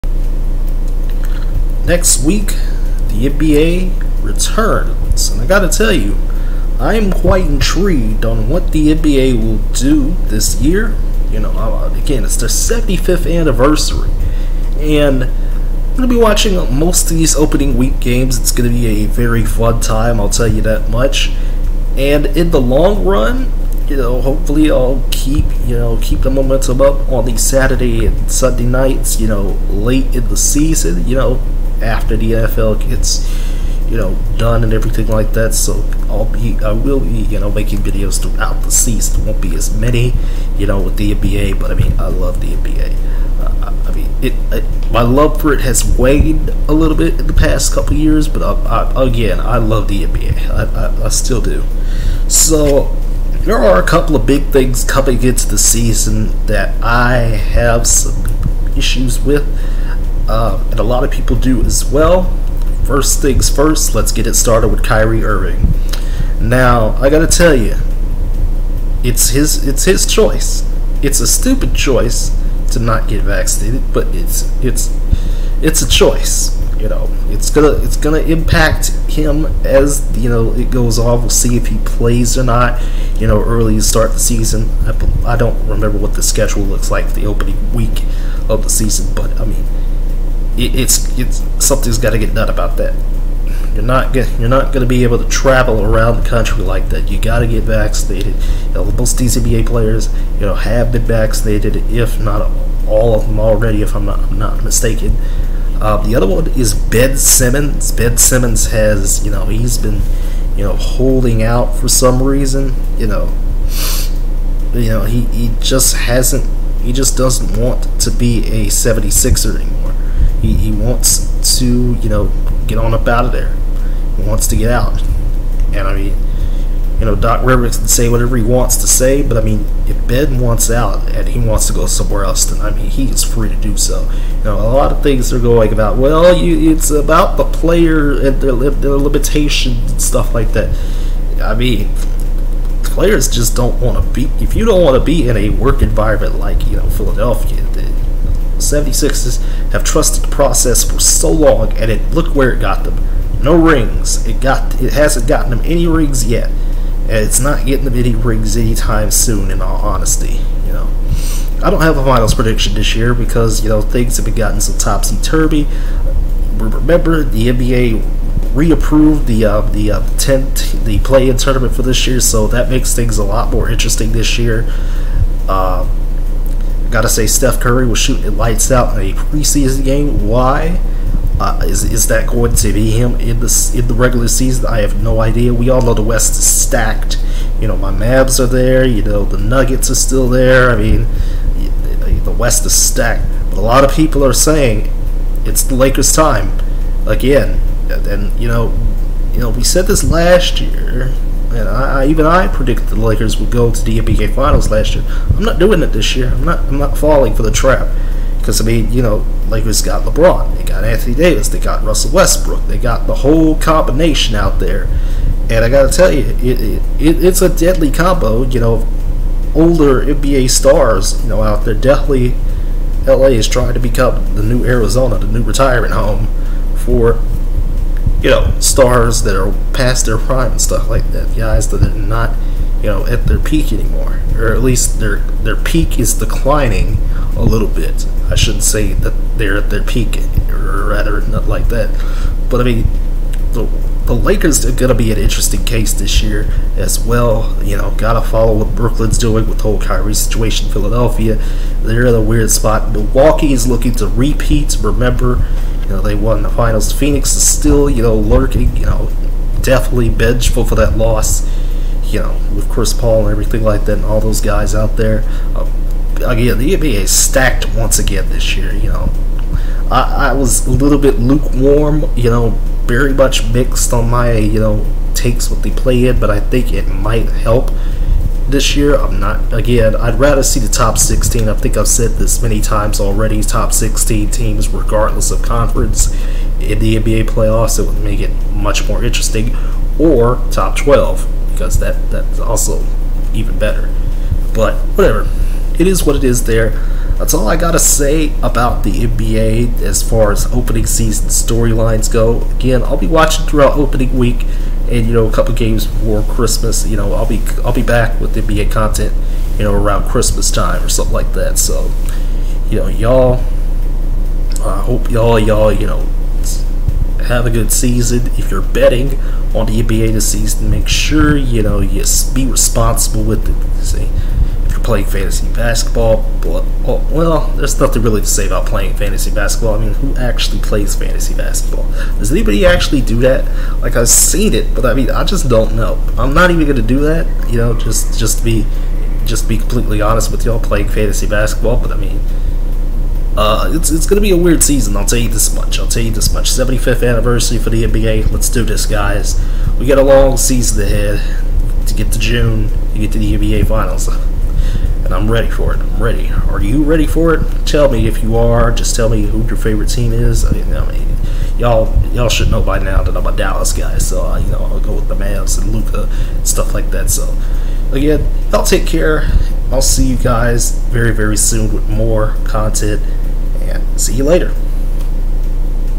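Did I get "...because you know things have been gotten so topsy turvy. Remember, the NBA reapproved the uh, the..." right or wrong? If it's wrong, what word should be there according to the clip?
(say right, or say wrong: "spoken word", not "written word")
right.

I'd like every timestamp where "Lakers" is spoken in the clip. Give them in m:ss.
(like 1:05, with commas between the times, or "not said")
3:15, 3:22, 3:29, 4:04.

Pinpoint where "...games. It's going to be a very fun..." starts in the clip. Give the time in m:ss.
0:17.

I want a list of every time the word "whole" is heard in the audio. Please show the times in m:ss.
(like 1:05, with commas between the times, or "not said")
3:33, 4:09.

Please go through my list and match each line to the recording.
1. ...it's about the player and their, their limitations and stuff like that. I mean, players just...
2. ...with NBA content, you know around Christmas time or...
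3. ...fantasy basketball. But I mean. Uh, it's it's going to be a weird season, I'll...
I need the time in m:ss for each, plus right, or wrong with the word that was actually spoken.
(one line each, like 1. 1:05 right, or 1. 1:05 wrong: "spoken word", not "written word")
1. 2:16 right
2. 5:08 right
3. 5:40 right.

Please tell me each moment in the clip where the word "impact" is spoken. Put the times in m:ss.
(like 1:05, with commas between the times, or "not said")
1:18.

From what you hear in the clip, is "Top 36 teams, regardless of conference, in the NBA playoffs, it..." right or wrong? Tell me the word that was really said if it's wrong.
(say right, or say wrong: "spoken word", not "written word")
wrong: "16", not "36".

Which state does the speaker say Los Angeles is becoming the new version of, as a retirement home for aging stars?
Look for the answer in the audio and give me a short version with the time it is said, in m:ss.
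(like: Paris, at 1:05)
Arizona, at 3:44.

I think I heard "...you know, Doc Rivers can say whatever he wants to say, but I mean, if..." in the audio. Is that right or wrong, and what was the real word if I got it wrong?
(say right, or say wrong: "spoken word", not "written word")
right.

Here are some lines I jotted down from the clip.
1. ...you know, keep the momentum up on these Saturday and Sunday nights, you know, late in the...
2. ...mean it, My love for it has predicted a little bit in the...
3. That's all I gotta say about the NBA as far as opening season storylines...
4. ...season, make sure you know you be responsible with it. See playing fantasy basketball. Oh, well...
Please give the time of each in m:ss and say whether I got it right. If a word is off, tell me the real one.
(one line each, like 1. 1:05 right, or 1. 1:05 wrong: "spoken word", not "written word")
1. 0:25 right
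2. 0:43 wrong: "waned", not "predicted"
3. 4:57 right
4. 5:20 right.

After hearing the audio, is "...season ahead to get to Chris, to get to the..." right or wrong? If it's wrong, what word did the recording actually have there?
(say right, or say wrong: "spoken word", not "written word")
wrong: "June", not "Chris".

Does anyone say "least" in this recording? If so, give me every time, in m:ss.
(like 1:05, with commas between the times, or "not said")
3:54.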